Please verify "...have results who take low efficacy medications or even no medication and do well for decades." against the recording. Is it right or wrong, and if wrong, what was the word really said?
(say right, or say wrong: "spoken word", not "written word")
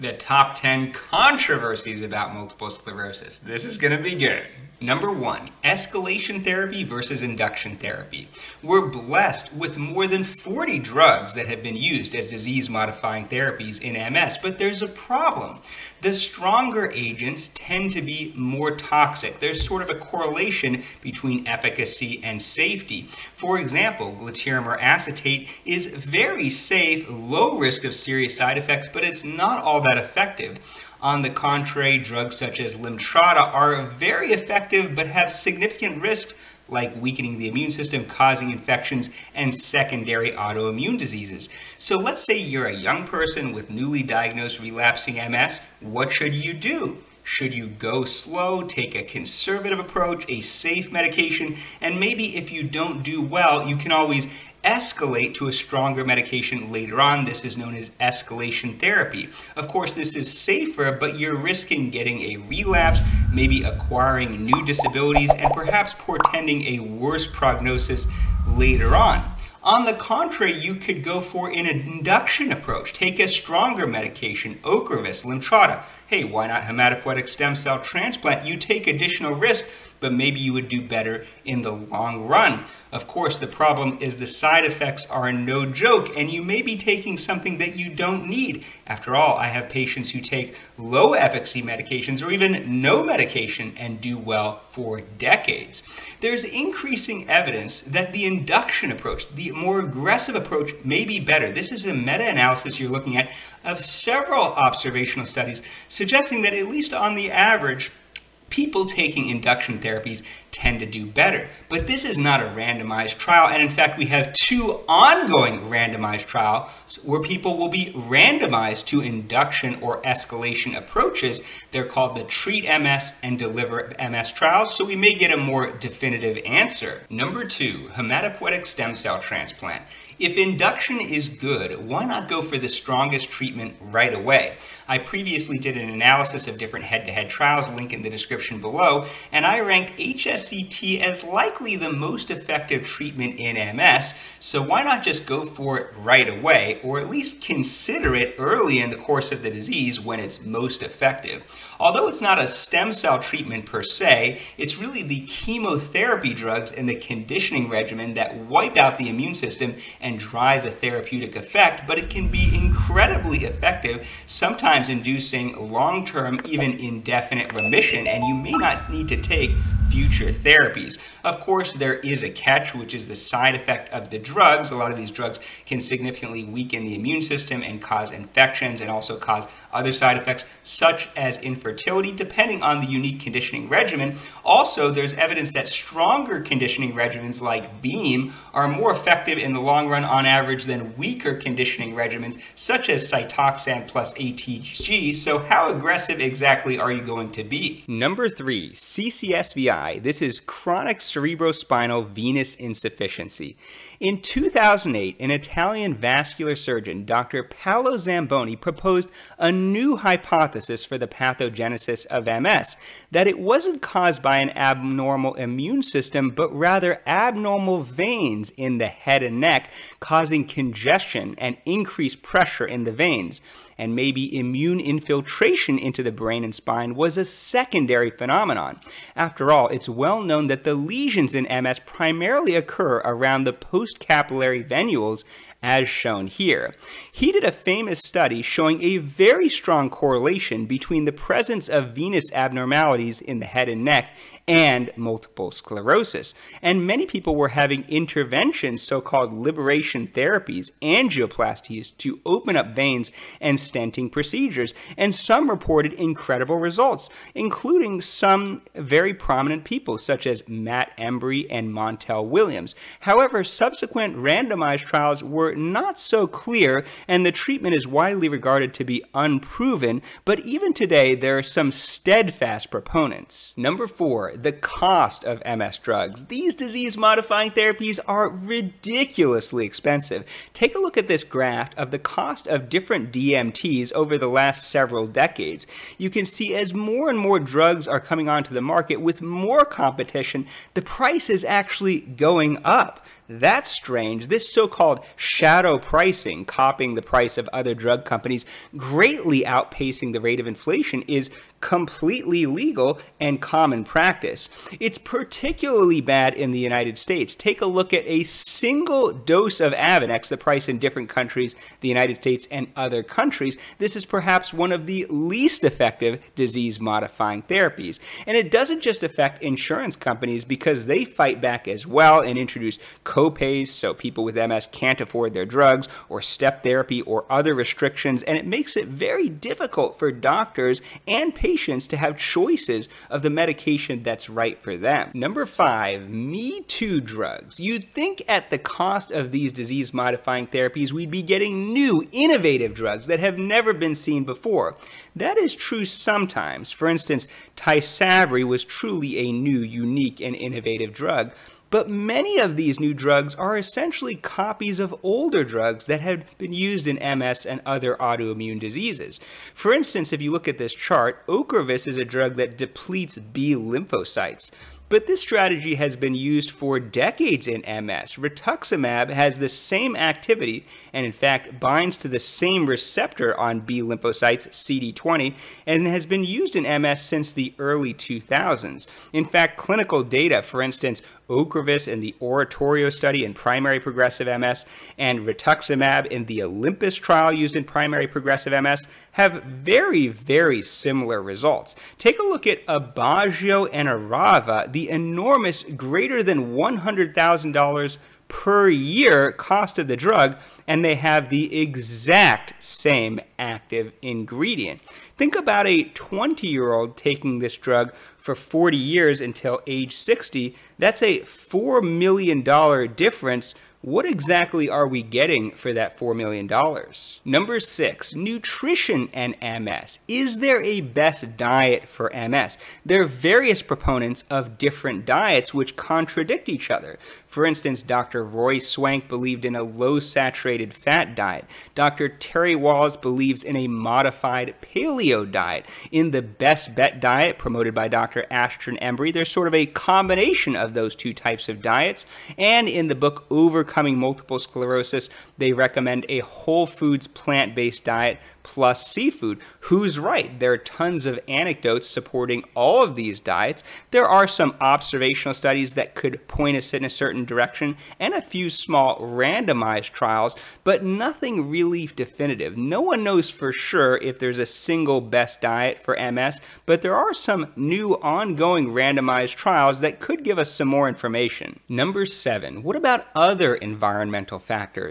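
wrong: "patients", not "results".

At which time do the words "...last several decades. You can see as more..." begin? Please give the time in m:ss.
4:44.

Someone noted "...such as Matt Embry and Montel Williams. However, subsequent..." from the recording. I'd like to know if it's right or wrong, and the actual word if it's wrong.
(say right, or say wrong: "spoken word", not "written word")
right.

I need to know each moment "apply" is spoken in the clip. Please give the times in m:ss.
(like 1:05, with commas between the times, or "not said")
not said.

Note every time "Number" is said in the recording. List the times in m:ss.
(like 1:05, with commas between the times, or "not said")
0:04, 2:07, 3:17, 4:33, 5:35, 6:57, 7:51.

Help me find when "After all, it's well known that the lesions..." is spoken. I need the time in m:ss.
3:49.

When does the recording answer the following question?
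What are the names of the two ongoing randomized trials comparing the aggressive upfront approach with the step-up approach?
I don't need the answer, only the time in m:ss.
2:02.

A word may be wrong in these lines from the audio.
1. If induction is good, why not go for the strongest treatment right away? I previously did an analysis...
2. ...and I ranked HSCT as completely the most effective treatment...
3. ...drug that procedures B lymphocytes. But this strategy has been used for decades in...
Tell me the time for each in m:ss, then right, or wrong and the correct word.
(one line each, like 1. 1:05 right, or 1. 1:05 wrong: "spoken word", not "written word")
1. 2:10 right
2. 2:19 wrong: "likely", not "completely"
3. 6:02 wrong: "depletes", not "procedures".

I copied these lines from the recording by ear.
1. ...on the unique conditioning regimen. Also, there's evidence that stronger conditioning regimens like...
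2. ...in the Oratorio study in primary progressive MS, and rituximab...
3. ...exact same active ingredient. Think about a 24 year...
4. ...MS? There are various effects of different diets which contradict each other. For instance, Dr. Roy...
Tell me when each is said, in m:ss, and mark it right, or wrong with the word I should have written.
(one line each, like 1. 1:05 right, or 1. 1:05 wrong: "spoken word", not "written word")
1. 3:02 right
2. 6:21 right
3. 6:41 wrong: "20", not "24"
4. 7:02 wrong: "proponents", not "effects".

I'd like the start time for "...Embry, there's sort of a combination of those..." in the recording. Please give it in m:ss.
7:18.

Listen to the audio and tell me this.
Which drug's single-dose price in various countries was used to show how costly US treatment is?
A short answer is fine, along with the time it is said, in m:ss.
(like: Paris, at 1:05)
Avonex, at 5:09.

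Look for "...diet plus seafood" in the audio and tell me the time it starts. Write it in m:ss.
7:27.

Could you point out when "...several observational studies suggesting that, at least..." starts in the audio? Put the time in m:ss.
1:43.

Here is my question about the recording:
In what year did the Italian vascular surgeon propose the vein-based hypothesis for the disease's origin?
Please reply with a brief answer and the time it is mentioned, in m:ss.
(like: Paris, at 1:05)
2008, at 3:24.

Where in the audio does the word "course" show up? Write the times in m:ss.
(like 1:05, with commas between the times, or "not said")
0:59, 1:23, 2:28, 2:51.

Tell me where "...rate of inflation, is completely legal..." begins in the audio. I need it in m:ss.
5:00.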